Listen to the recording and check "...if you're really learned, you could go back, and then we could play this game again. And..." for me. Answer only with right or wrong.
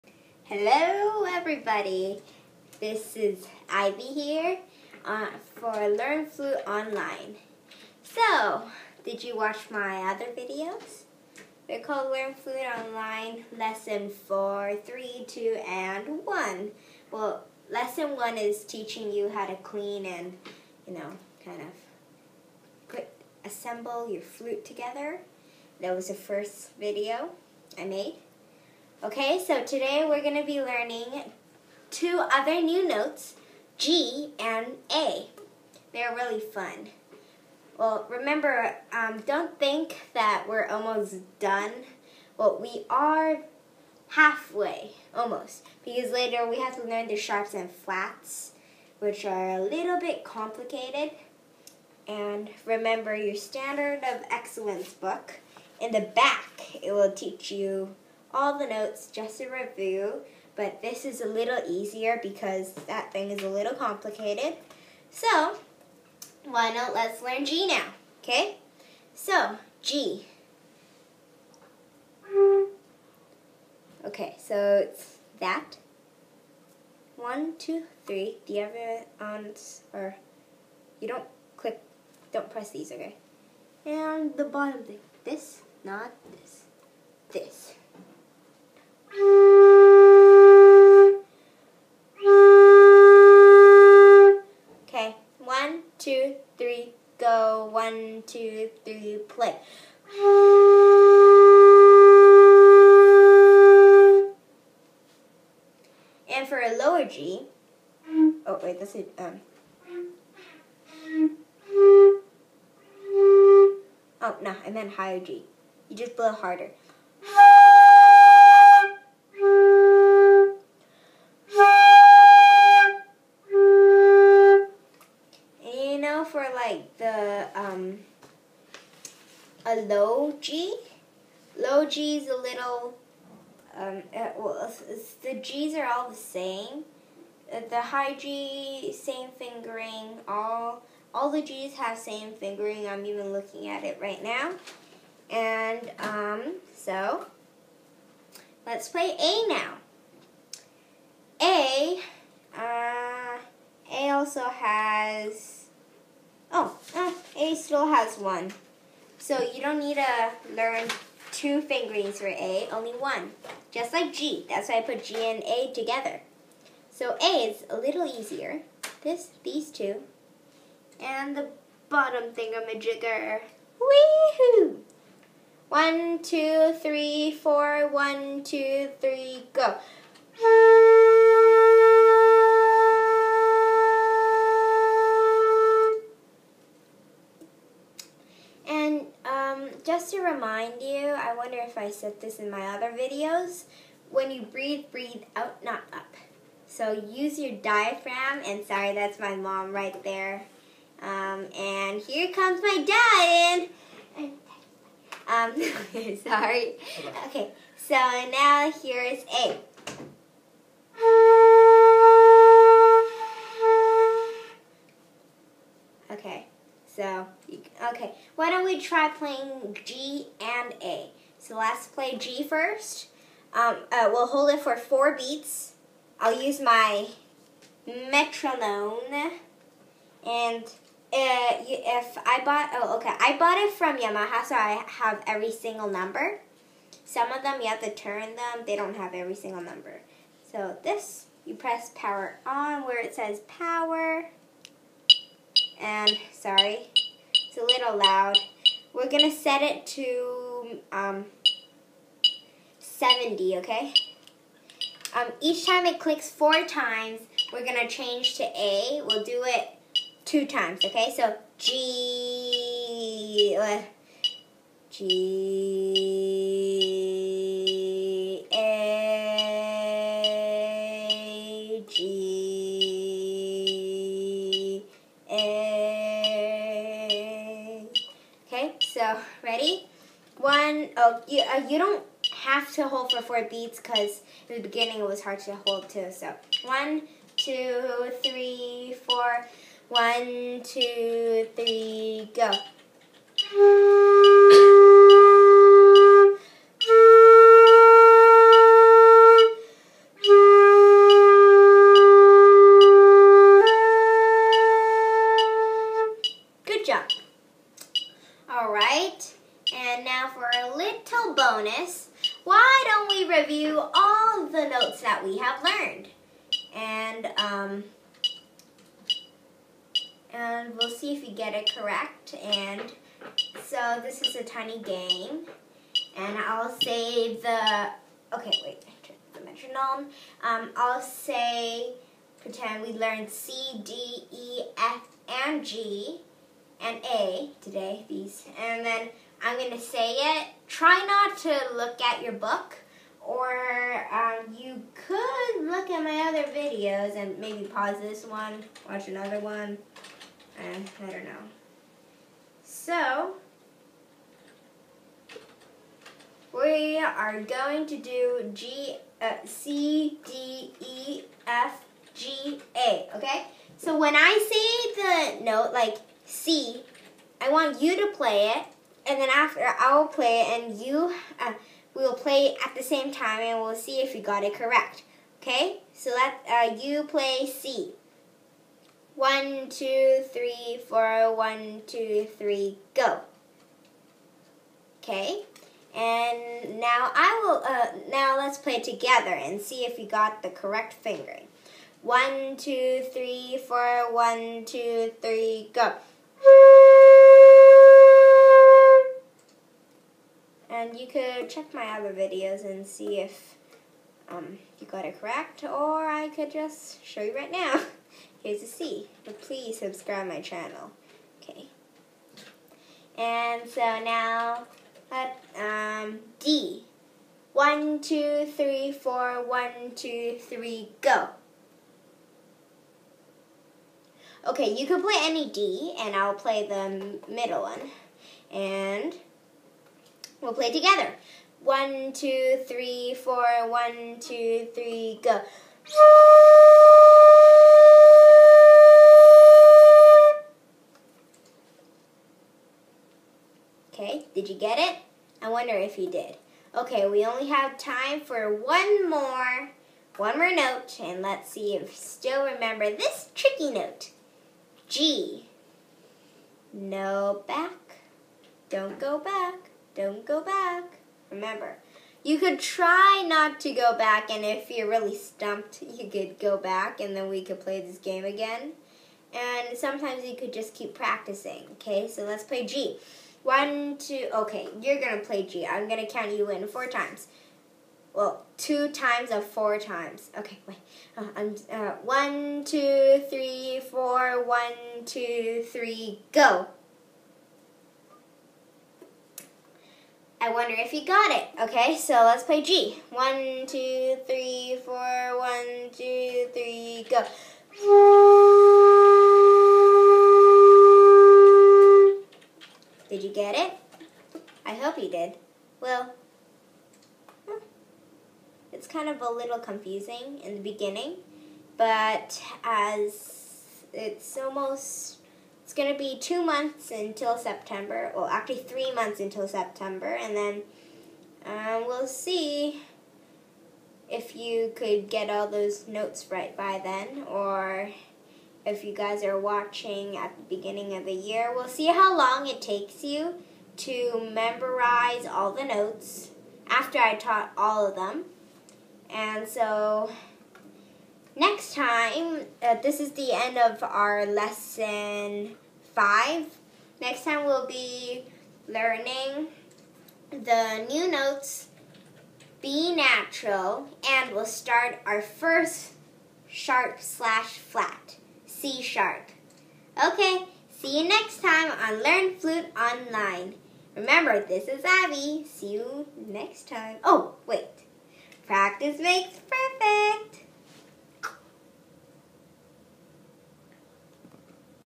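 wrong.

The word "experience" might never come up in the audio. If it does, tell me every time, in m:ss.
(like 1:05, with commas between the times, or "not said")
not said.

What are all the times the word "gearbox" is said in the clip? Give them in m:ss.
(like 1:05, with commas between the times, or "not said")
not said.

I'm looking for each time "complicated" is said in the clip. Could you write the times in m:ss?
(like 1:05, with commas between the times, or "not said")
0:50, 1:03.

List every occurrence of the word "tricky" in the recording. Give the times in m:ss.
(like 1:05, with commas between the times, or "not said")
7:33.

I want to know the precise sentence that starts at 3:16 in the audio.
So use your diaphragm, and sorry, that's my mom right there.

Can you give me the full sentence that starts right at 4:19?
We'll do it two times, okay?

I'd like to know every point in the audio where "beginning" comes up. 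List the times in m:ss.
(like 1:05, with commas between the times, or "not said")
4:44, 8:30, 8:50.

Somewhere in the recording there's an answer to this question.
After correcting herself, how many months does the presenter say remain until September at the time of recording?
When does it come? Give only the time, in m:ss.
8:38.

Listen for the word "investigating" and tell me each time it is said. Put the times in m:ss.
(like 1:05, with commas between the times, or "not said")
not said.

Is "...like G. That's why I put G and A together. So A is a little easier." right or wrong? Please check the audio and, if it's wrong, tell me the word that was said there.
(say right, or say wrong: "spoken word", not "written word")
right.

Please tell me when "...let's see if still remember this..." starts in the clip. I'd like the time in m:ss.
7:31.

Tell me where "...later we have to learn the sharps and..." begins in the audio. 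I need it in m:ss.
0:46.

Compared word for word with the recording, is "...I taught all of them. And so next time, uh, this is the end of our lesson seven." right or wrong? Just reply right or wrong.
wrong.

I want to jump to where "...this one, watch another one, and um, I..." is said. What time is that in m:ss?
5:48.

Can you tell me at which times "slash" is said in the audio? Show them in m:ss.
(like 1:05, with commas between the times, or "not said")
9:17.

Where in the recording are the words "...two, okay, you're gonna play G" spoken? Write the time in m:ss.
7:53.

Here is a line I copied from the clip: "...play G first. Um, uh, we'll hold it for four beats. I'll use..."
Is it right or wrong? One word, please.
right.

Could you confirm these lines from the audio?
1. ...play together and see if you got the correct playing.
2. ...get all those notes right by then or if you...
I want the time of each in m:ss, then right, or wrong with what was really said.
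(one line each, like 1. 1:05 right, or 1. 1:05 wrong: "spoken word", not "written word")
1. 6:28 wrong: "fingering", not "playing"
2. 8:45 right.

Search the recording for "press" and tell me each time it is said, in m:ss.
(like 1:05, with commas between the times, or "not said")
1:22, 4:01.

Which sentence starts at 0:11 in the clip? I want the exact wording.
They're called Learn Flute Online Lesson 4, 3, 2, and 1.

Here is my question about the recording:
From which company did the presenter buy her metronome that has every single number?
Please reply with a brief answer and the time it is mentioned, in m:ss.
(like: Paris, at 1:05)
Yamaha, at 3:53.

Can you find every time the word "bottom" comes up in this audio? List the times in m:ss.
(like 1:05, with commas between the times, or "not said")
1:24, 2:51.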